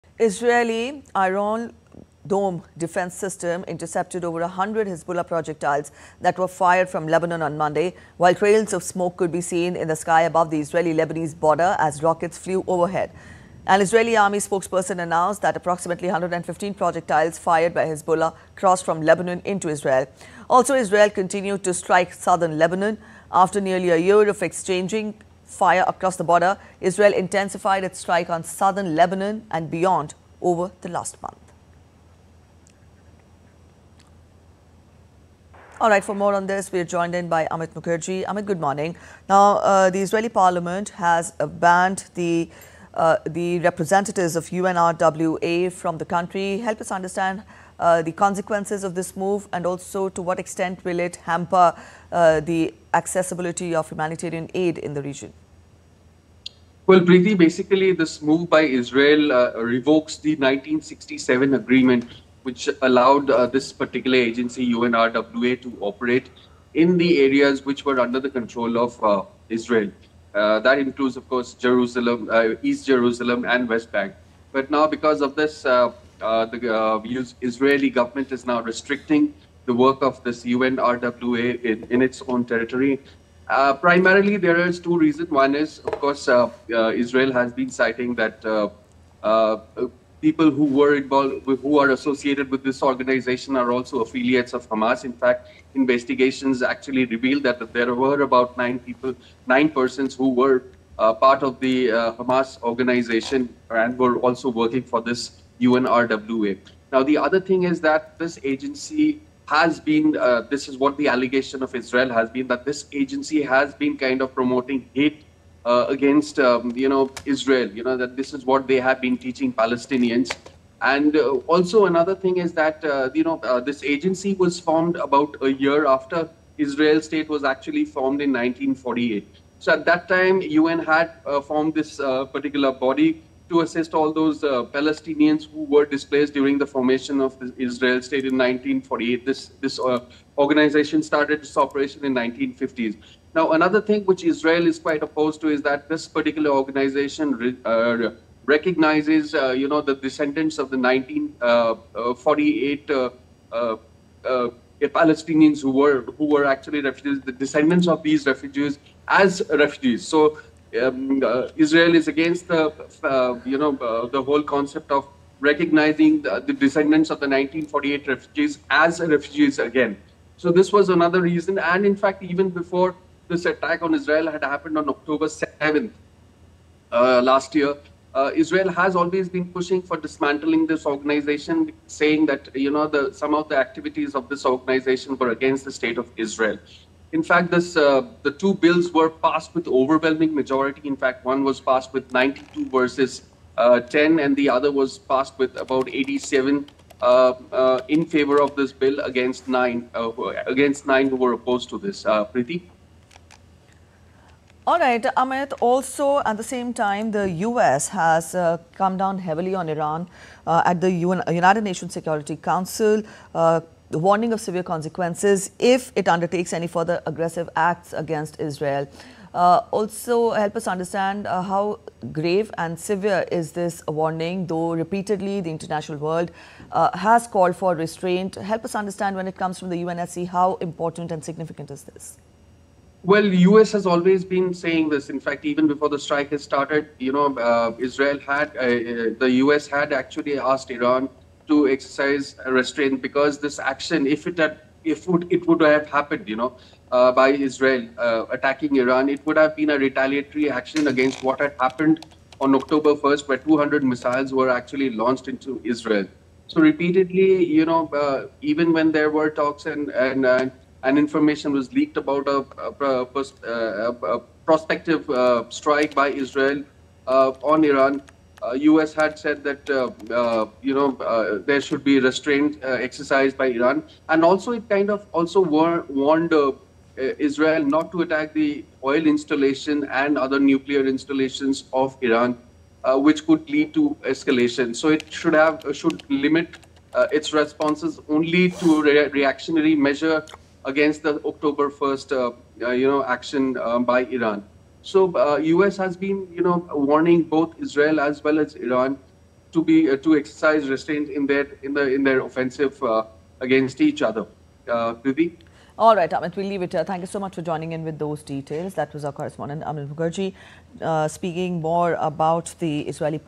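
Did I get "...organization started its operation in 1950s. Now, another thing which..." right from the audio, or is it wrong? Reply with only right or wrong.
right.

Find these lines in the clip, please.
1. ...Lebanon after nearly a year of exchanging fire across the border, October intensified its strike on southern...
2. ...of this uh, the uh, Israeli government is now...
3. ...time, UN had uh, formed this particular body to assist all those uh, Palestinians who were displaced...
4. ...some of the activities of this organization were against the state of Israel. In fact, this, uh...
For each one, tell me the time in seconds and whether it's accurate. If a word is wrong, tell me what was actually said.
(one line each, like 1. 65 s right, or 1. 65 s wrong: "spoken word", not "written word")
1. 22 s wrong: "Israel", not "October"
2. 75 s right
3. 130 s right
4. 183 s right.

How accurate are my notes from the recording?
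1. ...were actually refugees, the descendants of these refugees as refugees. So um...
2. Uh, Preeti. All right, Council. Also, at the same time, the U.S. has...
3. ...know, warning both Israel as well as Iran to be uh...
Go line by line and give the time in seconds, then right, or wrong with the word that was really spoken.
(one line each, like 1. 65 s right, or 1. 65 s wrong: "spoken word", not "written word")
1. 156 s right
2. 202 s wrong: "Amit", not "Council"
3. 296 s right.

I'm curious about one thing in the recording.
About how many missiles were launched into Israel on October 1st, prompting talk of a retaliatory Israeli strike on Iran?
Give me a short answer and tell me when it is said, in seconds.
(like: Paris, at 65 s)
200, at 253 s.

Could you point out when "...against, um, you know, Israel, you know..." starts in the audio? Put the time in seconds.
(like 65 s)
115 s.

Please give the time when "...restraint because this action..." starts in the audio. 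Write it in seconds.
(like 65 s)
242 s.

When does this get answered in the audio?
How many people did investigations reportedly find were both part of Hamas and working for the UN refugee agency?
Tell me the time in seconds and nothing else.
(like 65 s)
99 s.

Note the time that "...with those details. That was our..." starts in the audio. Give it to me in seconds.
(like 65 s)
307 s.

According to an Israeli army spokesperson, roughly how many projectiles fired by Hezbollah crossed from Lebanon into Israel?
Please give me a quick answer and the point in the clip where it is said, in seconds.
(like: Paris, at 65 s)
115, at 15 s.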